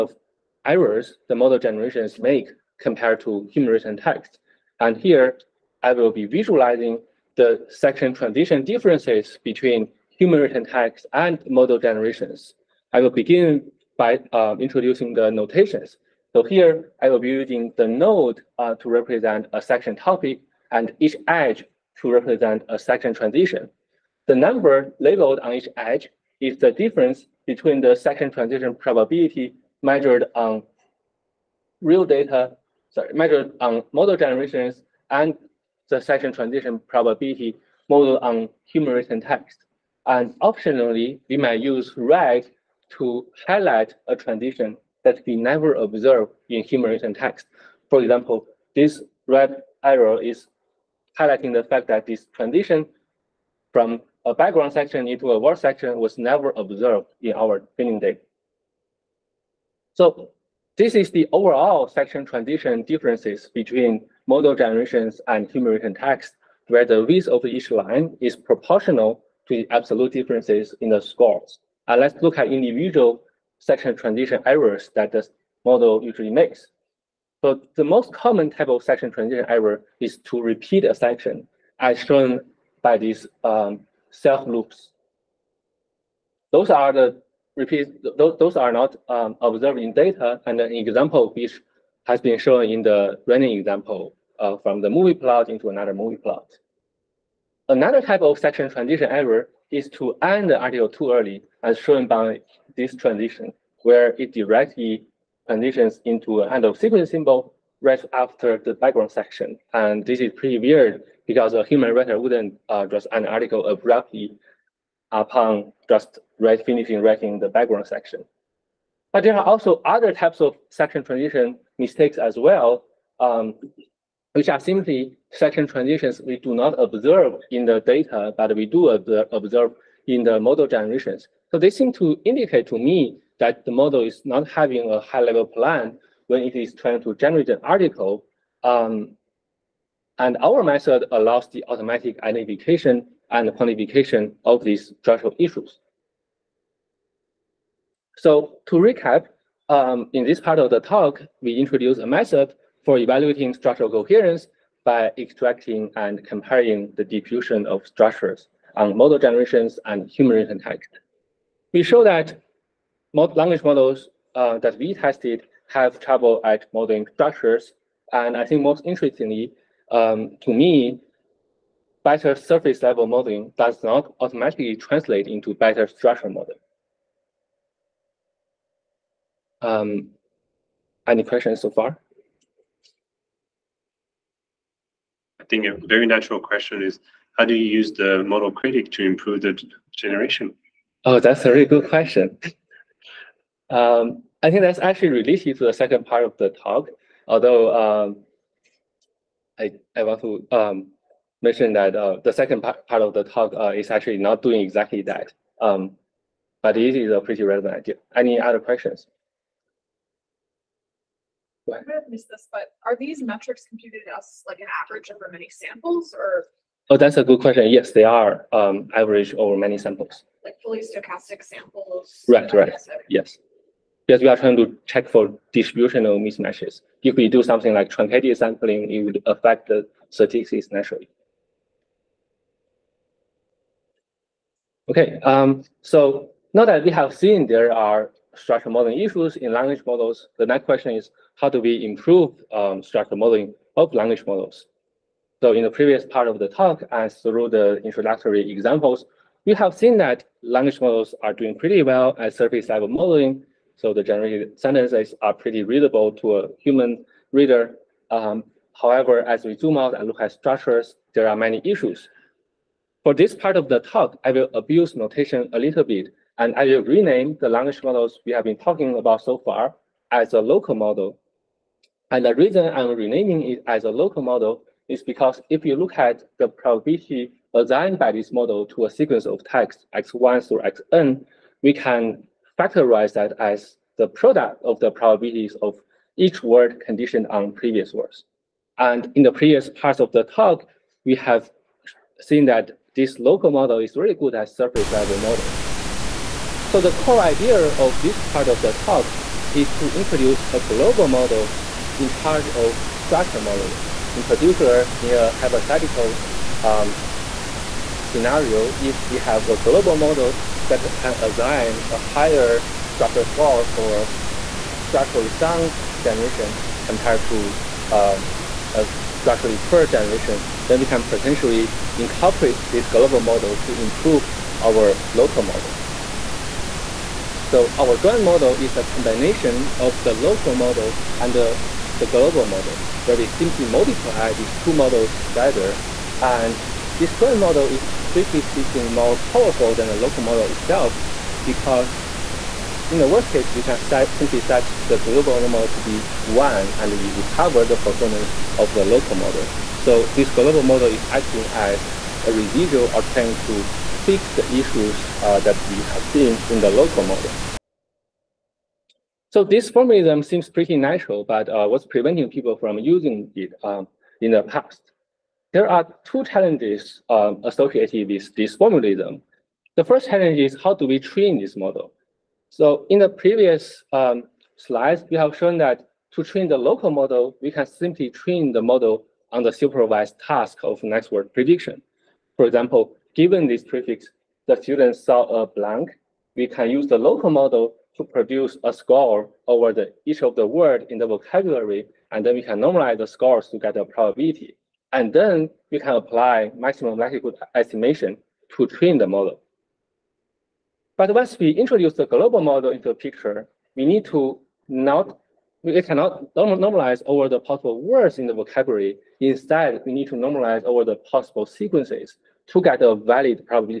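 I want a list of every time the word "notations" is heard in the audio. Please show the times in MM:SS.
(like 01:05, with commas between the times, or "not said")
00:15, 04:24.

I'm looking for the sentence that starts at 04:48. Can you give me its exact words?
And in the previous parts of the talk, we have seen that this local model is really good at surface level modeling.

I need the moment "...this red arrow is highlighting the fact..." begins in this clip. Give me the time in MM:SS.
00:48.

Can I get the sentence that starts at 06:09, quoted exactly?
The first challenge is how do we train this model?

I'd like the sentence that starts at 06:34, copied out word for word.
And then you can apply maximum likelihood estimation to train the model.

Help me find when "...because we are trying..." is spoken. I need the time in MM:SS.
03:44.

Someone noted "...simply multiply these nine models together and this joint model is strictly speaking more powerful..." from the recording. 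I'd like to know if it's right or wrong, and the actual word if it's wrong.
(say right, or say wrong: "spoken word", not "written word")
wrong: "two", not "nine".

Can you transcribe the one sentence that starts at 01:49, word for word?
And this is pretty weird because a human writer wouldn't uh, just an article abruptly upon just finishing writing the background section.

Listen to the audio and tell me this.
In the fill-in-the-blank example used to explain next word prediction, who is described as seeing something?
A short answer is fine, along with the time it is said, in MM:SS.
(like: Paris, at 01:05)
The student, at 06:24.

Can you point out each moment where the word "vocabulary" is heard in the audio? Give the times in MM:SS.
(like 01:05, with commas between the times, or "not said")
06:31, 06:48.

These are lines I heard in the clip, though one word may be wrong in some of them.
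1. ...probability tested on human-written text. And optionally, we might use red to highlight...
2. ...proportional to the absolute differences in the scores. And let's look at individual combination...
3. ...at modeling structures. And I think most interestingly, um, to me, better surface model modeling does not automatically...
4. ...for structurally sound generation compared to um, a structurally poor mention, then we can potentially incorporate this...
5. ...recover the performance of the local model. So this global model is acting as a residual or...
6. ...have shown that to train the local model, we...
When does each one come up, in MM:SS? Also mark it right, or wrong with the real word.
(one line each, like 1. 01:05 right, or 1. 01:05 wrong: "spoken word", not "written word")
1. 00:36 wrong: "modeled", not "tested"
2. 01:08 wrong: "section", not "combination"
3. 02:46 wrong: "level", not "model"
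4. 05:13 wrong: "generation", not "mention"
5. 05:47 right
6. 06:15 right.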